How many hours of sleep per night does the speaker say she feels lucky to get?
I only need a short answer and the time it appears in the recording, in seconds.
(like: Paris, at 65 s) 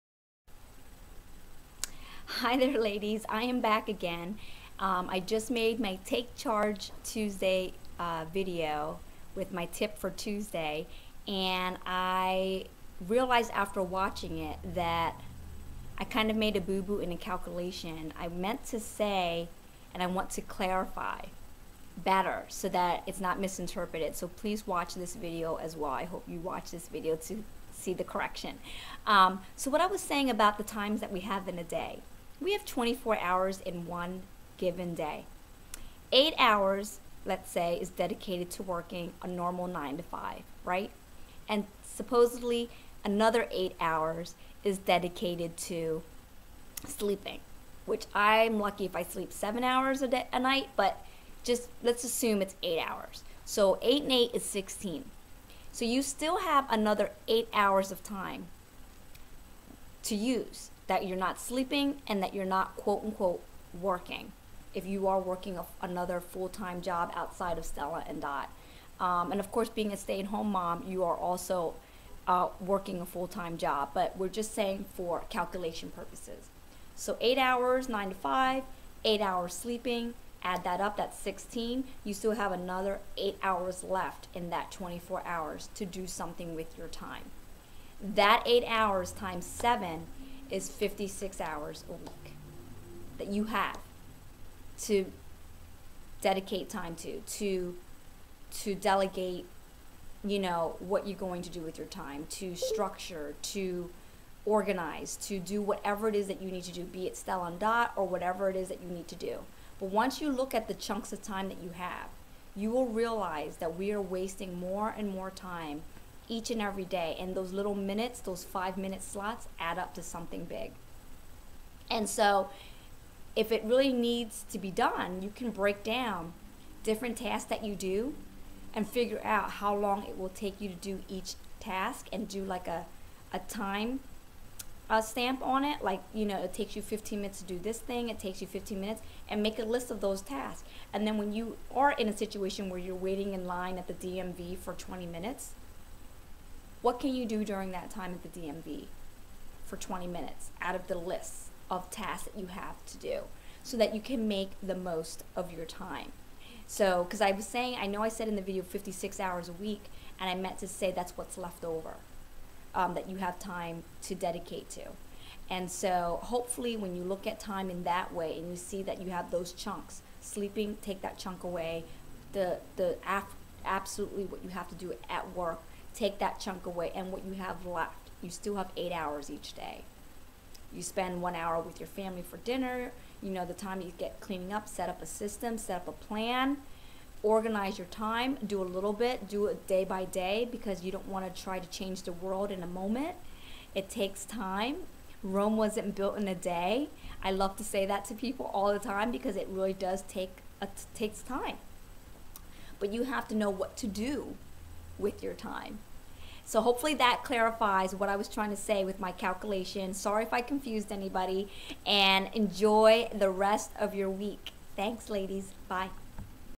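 7, at 49 s.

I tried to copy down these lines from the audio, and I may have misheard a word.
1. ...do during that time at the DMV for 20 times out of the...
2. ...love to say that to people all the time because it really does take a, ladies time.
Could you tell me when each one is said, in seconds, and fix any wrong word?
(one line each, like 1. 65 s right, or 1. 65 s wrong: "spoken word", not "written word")
1. 147 s wrong: "minutes", not "times"
2. 197 s wrong: "takes", not "ladies".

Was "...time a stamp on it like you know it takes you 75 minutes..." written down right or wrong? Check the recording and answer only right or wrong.
wrong.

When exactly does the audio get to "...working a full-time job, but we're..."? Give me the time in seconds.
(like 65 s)
72 s.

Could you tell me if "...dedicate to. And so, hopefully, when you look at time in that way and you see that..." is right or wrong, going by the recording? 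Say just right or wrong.
right.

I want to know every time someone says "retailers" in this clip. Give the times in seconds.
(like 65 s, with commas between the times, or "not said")
not said.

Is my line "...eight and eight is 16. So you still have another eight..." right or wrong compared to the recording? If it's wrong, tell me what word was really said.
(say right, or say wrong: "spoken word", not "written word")
right.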